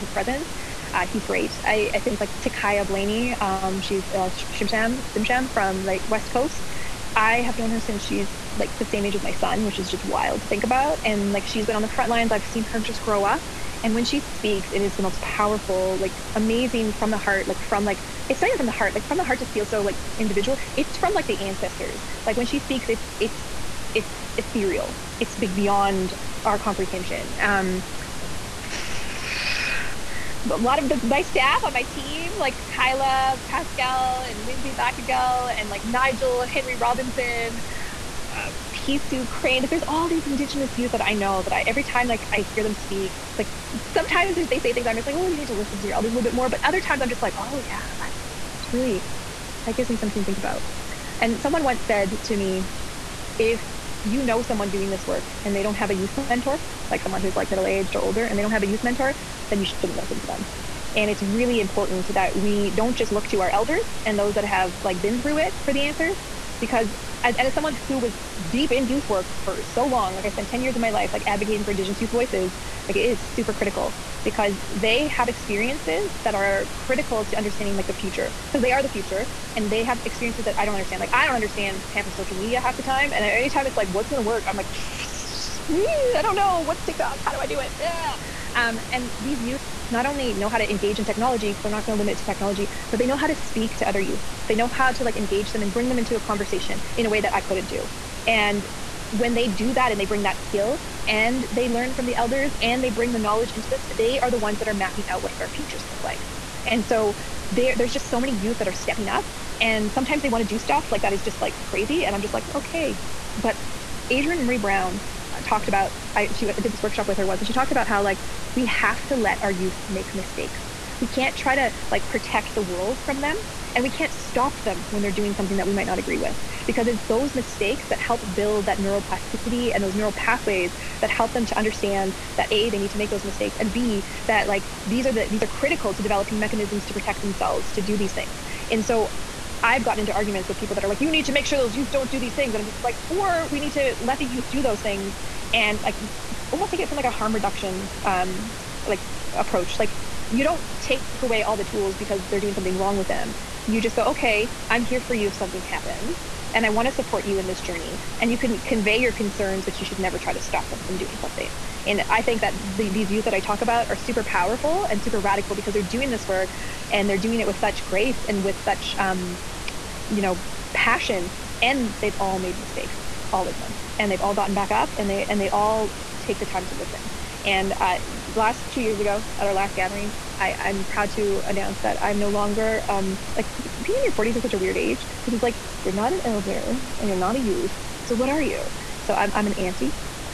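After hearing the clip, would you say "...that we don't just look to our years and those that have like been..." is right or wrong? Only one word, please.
wrong.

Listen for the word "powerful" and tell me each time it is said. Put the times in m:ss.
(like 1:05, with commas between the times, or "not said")
0:15, 2:44.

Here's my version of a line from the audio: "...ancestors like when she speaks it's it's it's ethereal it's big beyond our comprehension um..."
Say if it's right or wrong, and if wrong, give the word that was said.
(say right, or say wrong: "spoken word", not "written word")
right.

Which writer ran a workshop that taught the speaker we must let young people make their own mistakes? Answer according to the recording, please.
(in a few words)
adrienne maree brown.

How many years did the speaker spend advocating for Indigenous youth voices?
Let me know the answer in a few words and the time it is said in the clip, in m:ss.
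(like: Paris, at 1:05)
10, at 1:10.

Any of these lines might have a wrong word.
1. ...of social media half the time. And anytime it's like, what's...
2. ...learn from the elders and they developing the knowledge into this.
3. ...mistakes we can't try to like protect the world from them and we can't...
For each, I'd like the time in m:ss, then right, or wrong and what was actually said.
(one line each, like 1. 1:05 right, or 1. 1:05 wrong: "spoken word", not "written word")
1. 1:22 right
2. 1:41 wrong: "bring", not "developing"
3. 2:00 right.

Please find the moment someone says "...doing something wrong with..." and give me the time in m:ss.
2:32.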